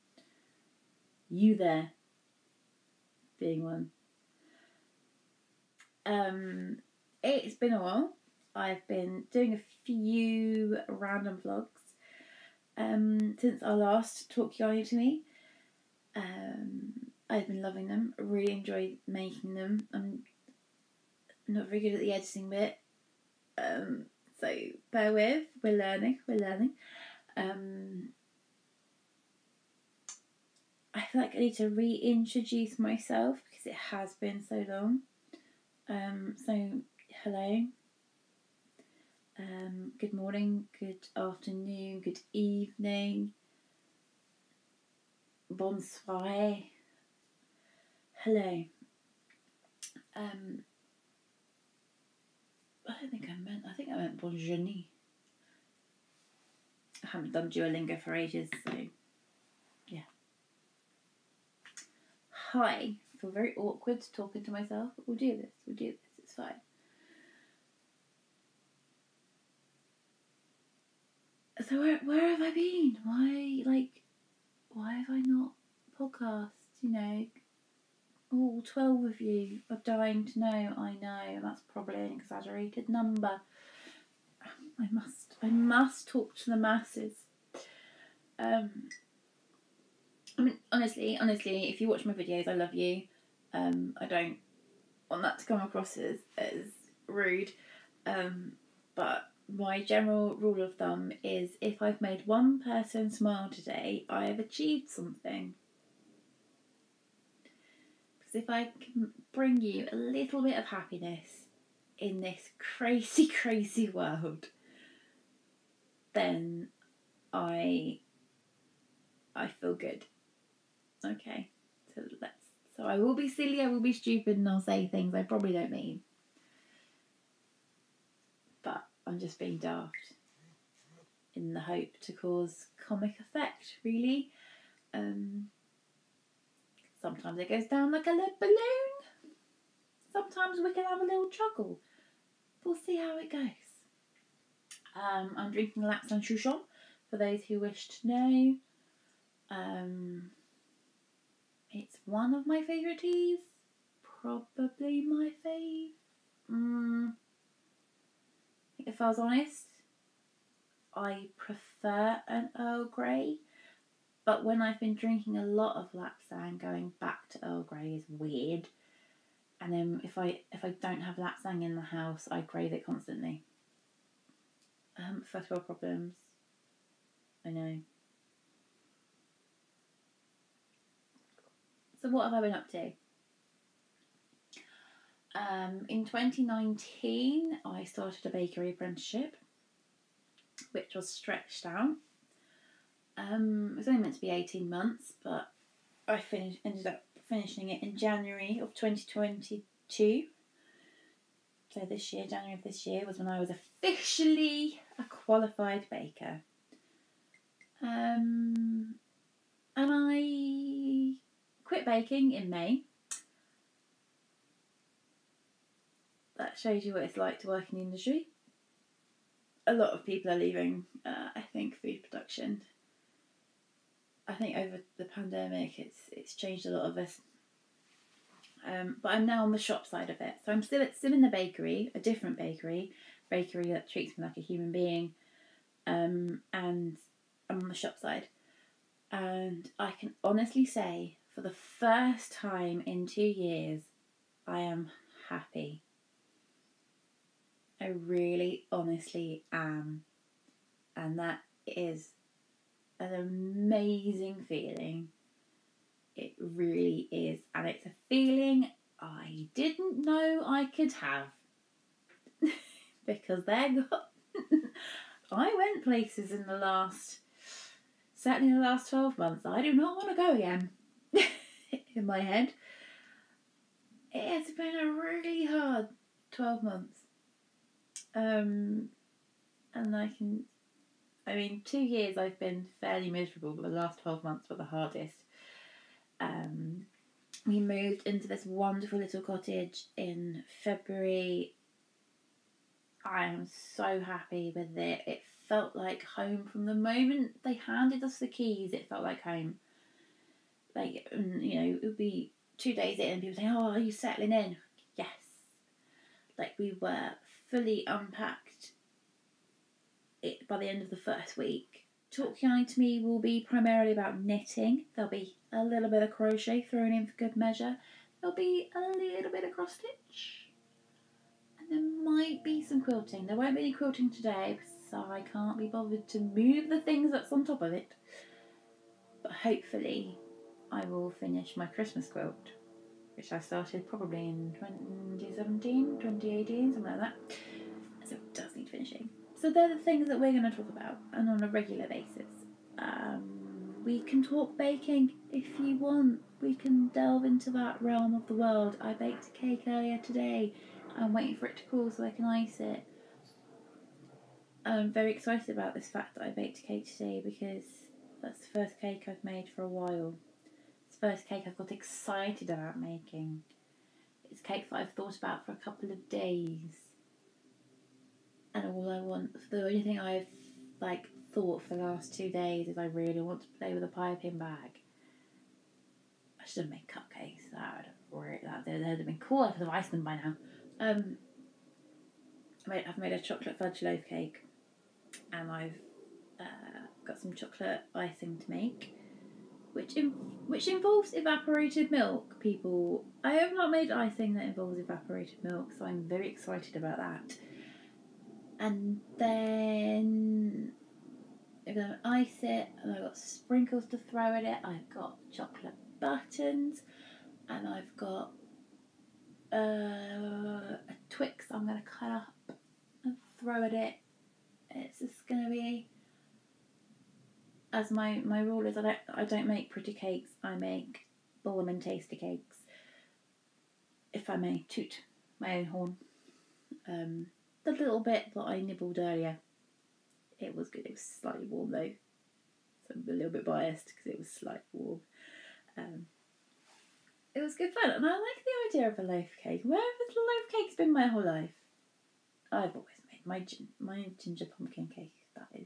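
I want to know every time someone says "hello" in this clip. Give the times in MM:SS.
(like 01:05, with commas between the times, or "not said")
00:37, 00:48.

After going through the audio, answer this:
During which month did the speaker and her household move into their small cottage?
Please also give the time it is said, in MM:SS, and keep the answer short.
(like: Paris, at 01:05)
February, at 04:50.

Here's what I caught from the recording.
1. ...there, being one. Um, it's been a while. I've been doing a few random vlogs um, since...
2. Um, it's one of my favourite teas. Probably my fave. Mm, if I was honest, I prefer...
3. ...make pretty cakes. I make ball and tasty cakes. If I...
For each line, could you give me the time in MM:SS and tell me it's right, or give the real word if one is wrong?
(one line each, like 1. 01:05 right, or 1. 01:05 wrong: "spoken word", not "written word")
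1. 00:01 right
2. 02:29 right
3. 06:59 right.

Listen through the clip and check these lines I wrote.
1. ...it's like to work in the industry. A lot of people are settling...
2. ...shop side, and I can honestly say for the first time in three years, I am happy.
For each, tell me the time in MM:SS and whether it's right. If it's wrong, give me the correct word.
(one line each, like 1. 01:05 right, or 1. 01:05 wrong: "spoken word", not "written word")
1. 03:37 wrong: "leaving", not "settling"
2. 03:57 wrong: "two", not "three".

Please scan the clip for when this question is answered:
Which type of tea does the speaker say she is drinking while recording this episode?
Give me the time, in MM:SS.
02:25.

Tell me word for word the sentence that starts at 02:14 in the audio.
Um, sometimes it goes down like a lead balloon.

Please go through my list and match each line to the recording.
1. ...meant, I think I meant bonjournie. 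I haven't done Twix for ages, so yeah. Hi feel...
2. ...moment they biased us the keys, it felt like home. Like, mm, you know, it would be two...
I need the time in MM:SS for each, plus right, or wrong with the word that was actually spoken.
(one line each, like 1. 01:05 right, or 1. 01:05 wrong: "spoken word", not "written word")
1. 00:53 wrong: "Duolingo", not "Twix"
2. 04:56 wrong: "handed", not "biased".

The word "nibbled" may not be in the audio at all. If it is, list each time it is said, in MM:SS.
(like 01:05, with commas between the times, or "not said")
07:08.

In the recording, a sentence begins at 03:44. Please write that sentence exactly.
I think over the pandemic, it's it's changed a lot of us.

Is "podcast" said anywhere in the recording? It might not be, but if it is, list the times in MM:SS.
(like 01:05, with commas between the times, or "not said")
01:15.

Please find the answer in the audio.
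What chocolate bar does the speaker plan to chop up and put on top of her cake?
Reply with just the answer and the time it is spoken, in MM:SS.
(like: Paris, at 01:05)
Twix, at 06:51.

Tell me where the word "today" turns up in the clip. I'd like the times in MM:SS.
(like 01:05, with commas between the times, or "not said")
01:43, 05:24, 05:49, 05:56.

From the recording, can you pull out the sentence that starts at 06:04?
It's cake that I've thought about for a couple of days.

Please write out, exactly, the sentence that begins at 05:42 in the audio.
Um, we can talk baking if you want.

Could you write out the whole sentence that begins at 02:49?
And then if I if I don't have Lapsang in the house, I crave it constantly.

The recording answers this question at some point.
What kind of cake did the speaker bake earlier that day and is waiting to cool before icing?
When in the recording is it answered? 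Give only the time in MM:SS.
06:23.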